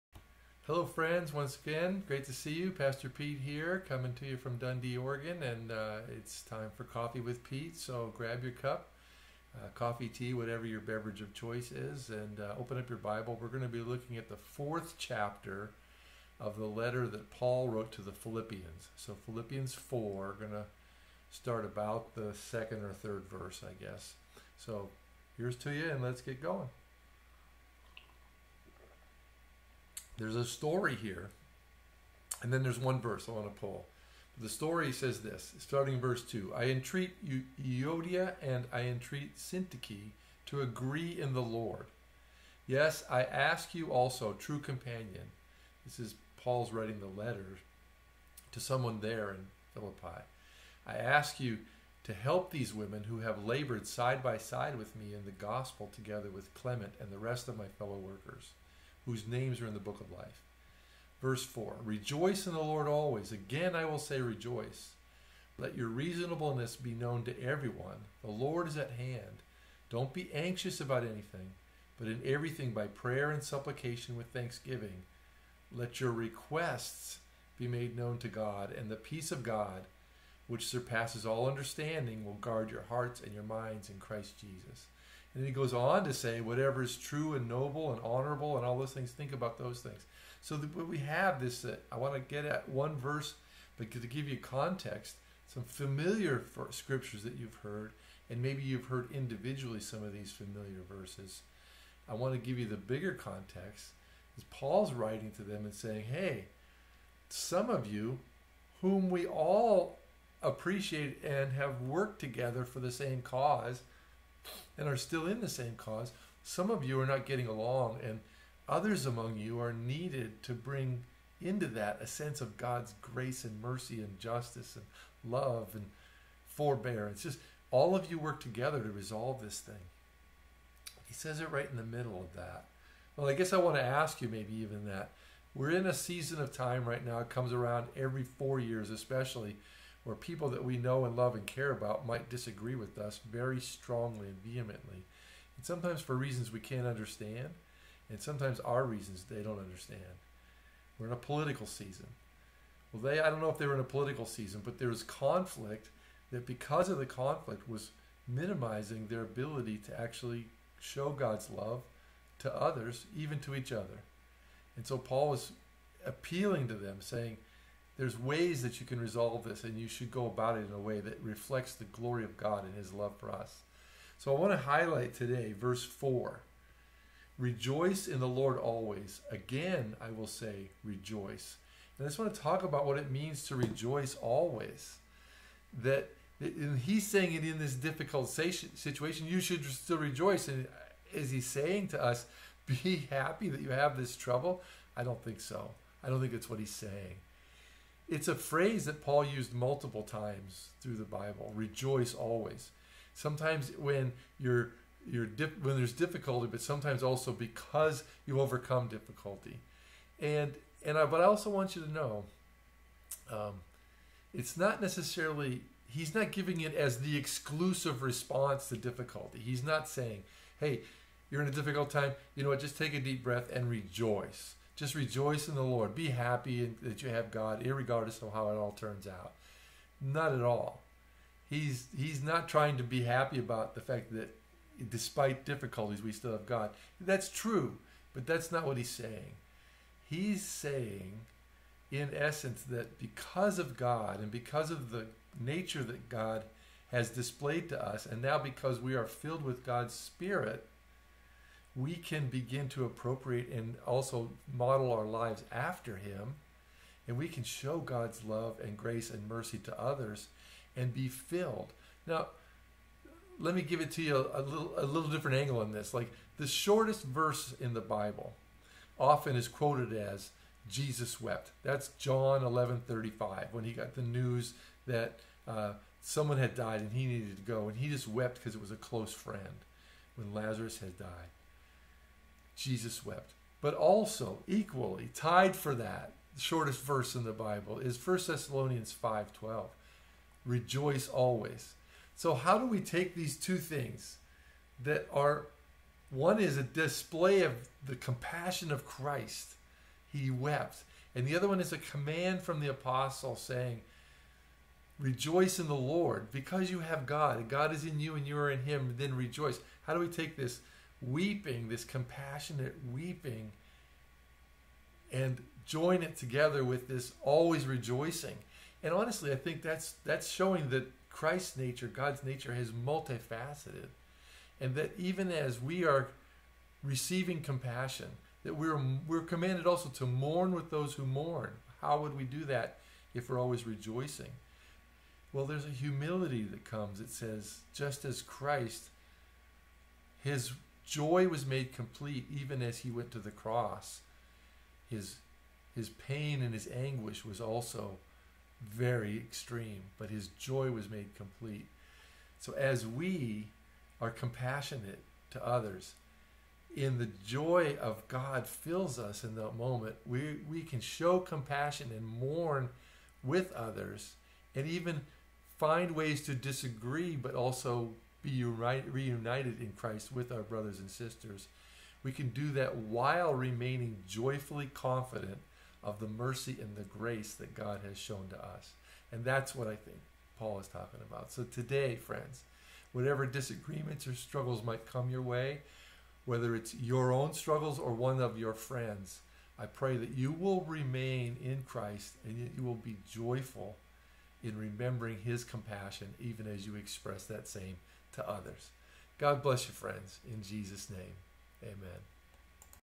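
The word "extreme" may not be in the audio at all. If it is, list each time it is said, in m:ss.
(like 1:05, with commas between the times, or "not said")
5:49.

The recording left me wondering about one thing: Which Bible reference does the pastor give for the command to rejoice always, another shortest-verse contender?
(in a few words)
1 Thessalonians 5:12.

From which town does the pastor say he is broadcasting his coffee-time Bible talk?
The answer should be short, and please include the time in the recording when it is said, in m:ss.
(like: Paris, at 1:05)
Dundee, Oregon, at 0:04.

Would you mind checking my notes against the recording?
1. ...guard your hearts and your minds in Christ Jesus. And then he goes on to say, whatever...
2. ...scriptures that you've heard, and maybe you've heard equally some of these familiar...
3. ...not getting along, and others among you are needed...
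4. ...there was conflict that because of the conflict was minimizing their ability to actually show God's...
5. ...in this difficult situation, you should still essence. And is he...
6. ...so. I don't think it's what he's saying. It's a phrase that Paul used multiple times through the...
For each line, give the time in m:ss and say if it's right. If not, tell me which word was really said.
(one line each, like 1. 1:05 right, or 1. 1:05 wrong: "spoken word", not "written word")
1. 1:22 right
2. 1:36 wrong: "individually", not "equally"
3. 1:57 right
4. 2:34 right
5. 3:07 wrong: "rejoice", not "essence"
6. 3:15 right.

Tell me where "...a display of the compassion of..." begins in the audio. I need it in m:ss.
4:56.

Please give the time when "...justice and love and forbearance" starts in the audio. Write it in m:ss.
2:04.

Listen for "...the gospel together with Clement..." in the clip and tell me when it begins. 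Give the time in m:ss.
0:55.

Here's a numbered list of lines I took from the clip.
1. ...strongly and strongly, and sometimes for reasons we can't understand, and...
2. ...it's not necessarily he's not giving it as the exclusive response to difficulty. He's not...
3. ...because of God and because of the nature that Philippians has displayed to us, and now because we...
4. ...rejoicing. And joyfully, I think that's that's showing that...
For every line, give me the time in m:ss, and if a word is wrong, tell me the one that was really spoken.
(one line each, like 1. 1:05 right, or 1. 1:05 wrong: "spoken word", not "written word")
1. 2:23 wrong: "vehemently", not "strongly"
2. 3:34 right
3. 4:02 wrong: "God", not "Philippians"
4. 5:17 wrong: "honestly", not "joyfully".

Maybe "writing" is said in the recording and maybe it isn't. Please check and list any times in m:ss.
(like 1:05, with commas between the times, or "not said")
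0:46, 1:44.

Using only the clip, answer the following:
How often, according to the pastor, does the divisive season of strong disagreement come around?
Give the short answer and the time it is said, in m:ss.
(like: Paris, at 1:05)
every 4 years, at 2:17.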